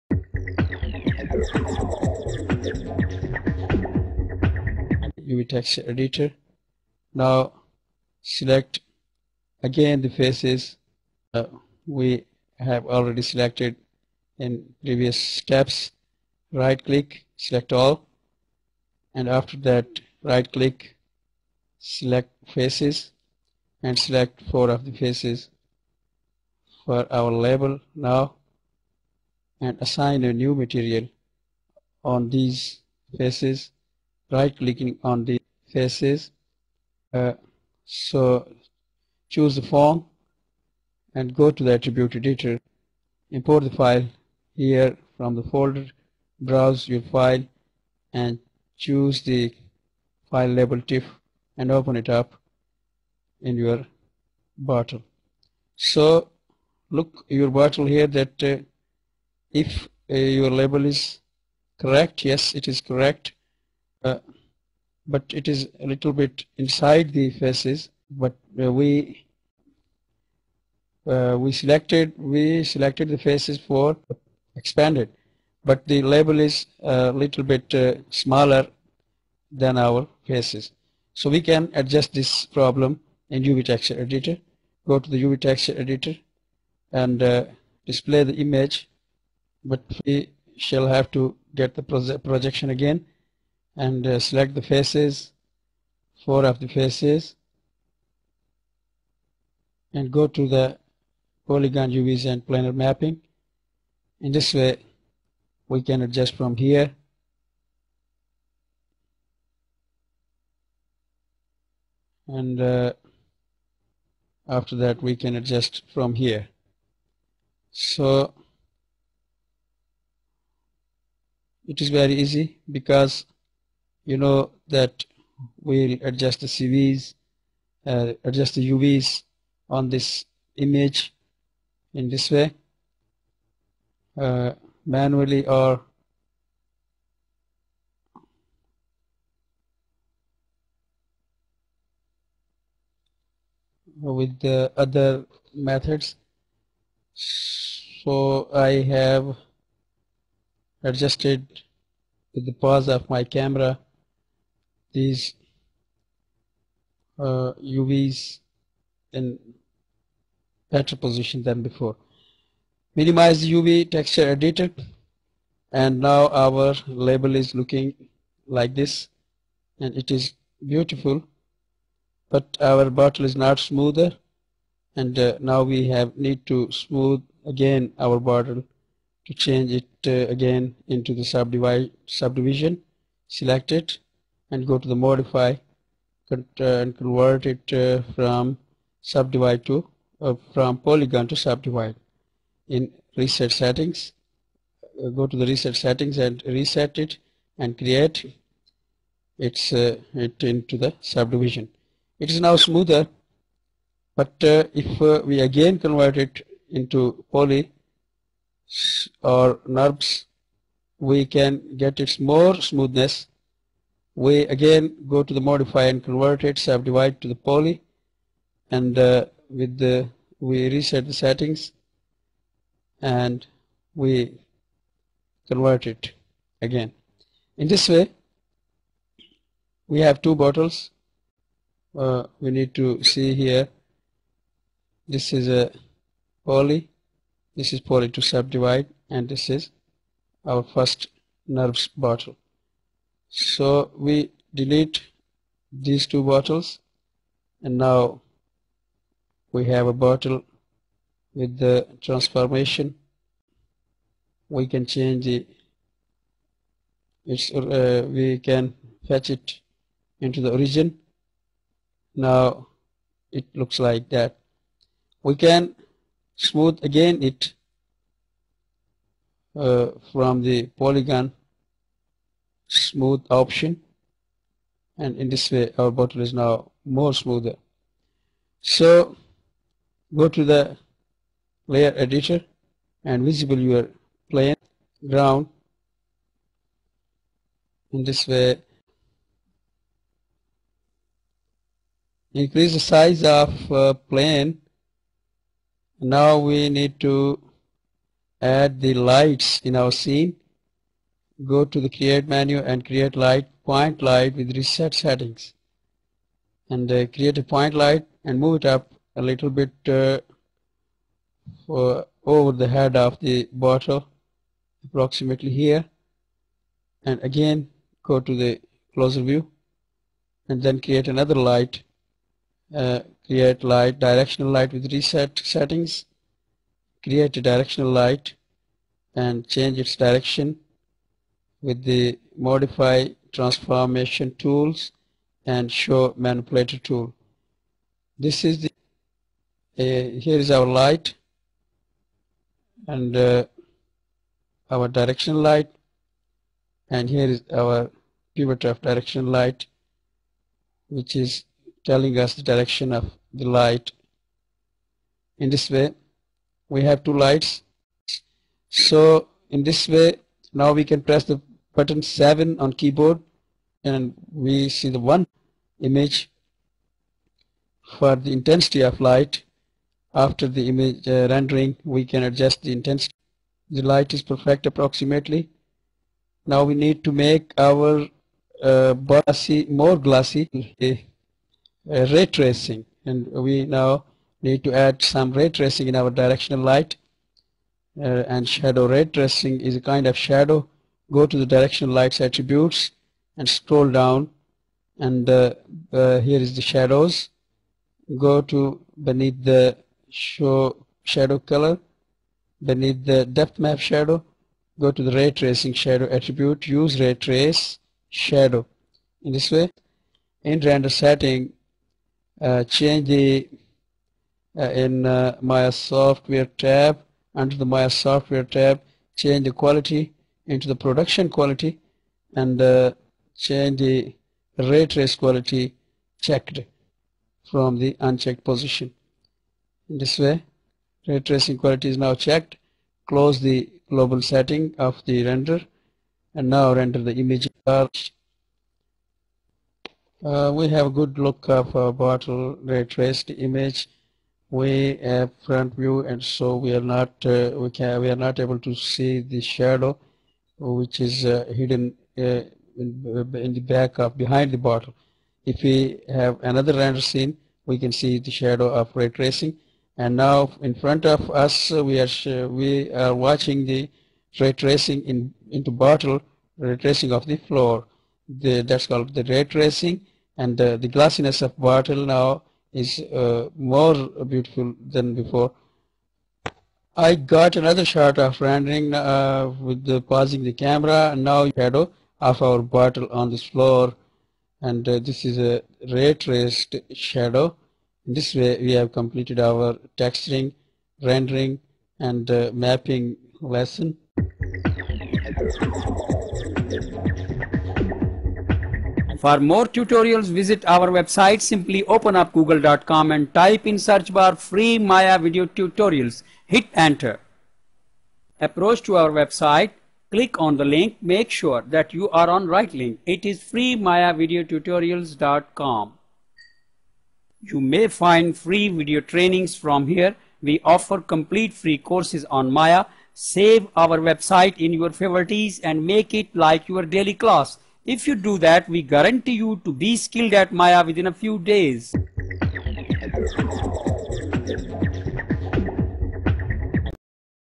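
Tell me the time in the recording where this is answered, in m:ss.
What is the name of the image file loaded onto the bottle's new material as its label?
0:50.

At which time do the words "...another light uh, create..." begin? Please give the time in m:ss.
5:21.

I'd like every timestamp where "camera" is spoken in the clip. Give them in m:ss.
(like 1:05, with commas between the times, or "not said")
2:33, 8:00.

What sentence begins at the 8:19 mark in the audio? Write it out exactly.
For more tutorials, visit our website.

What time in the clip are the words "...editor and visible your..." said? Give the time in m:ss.
4:41.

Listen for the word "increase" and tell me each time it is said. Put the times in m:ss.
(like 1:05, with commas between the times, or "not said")
4:52.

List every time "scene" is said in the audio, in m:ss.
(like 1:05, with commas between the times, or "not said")
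4:59, 7:37.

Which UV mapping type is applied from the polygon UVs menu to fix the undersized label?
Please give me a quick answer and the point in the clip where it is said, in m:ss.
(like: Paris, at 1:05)
planar mapping, at 1:42.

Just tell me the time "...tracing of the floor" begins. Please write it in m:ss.
7:46.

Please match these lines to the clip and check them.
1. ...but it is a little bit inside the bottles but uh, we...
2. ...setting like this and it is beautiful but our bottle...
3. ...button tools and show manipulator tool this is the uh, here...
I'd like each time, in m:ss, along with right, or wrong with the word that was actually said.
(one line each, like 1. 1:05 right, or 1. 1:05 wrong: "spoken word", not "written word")
1. 1:05 wrong: "faces", not "bottles"
2. 2:47 wrong: "looking", not "setting"
3. 5:33 wrong: "transformation", not "button".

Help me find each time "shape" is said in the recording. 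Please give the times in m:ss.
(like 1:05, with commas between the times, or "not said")
not said.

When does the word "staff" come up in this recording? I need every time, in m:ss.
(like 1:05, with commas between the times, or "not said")
not said.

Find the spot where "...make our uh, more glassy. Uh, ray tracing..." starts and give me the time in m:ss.
6:17.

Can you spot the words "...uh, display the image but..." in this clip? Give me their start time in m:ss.
1:27.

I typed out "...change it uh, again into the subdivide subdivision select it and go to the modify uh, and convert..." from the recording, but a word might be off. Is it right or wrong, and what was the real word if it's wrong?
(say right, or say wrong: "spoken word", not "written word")
right.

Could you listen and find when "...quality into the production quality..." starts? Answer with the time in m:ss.
6:59.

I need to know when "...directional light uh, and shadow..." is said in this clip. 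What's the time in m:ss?
6:26.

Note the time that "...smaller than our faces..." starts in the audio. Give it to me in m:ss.
1:18.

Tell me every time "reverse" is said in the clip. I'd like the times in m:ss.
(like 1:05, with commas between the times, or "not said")
not said.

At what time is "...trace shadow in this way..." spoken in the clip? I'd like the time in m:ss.
6:47.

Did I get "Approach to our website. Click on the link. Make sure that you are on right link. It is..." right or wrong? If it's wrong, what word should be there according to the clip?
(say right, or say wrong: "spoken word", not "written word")
right.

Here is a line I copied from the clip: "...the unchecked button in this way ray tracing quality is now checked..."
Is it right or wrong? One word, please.
wrong.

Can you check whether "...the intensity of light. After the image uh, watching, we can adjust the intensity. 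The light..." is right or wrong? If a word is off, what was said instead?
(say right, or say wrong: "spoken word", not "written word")
wrong: "rendering", not "watching".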